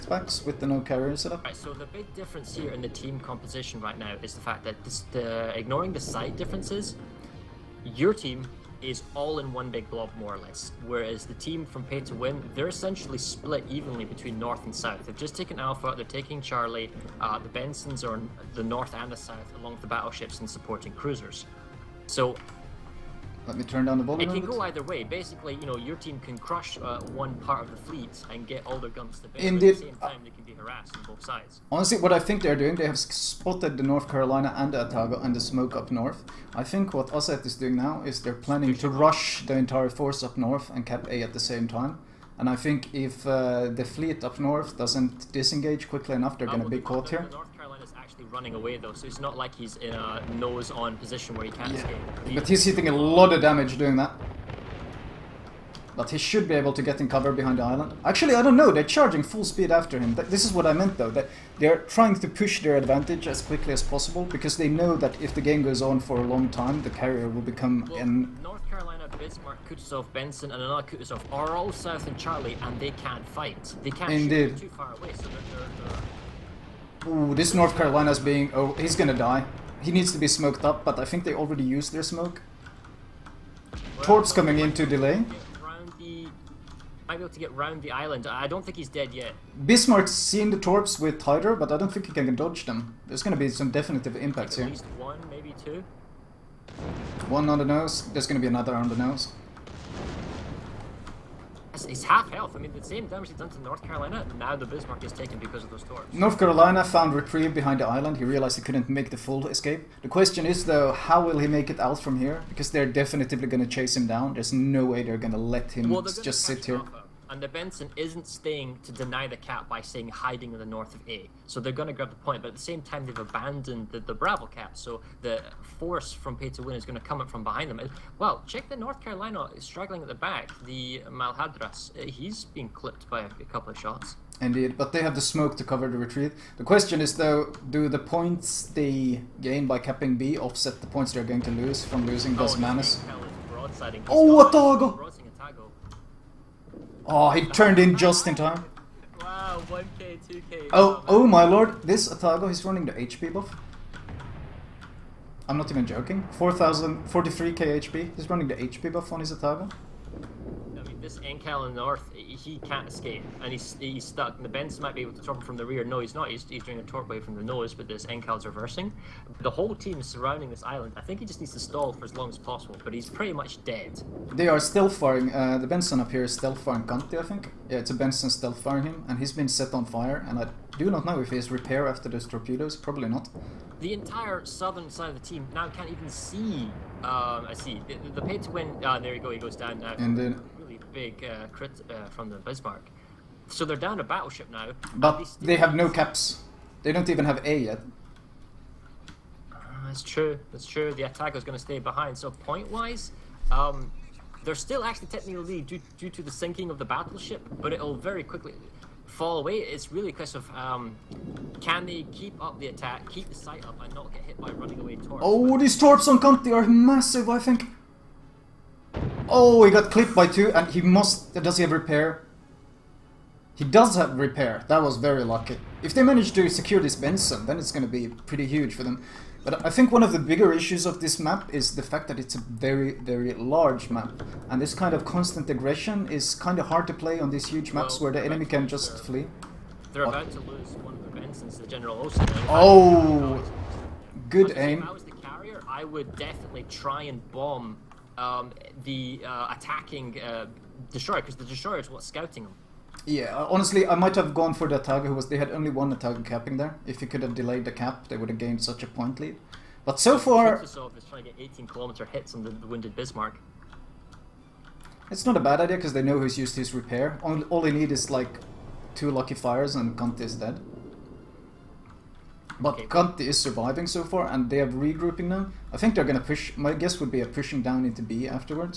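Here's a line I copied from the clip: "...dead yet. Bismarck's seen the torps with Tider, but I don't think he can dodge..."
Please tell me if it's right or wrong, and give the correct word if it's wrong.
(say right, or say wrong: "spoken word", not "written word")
right.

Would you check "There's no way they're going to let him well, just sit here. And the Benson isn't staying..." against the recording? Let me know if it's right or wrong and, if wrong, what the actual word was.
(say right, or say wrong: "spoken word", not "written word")
right.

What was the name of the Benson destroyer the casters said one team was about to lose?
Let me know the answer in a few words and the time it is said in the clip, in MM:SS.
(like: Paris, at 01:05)
General Osterman, at 04:01.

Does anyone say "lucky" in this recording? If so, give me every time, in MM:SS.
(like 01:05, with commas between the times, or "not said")
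03:45, 04:29.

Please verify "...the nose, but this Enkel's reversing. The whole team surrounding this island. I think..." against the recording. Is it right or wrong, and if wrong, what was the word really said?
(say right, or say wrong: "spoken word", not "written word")
right.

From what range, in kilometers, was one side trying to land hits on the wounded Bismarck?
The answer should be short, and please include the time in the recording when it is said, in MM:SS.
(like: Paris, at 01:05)
18, at 04:21.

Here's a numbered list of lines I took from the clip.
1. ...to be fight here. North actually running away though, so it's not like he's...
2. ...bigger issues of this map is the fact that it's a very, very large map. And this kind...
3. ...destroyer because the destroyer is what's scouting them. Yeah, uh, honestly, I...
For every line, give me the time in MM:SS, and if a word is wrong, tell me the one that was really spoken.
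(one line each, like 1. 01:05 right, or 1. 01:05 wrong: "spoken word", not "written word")
1. 00:46 wrong: "caught", not "fight"
2. 03:50 right
3. 04:10 right.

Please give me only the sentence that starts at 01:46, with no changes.
North Carolina found reprieve behind the island.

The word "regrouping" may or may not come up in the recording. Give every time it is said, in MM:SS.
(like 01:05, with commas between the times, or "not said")
04:34.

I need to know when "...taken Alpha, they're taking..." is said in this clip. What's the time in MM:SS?
00:15.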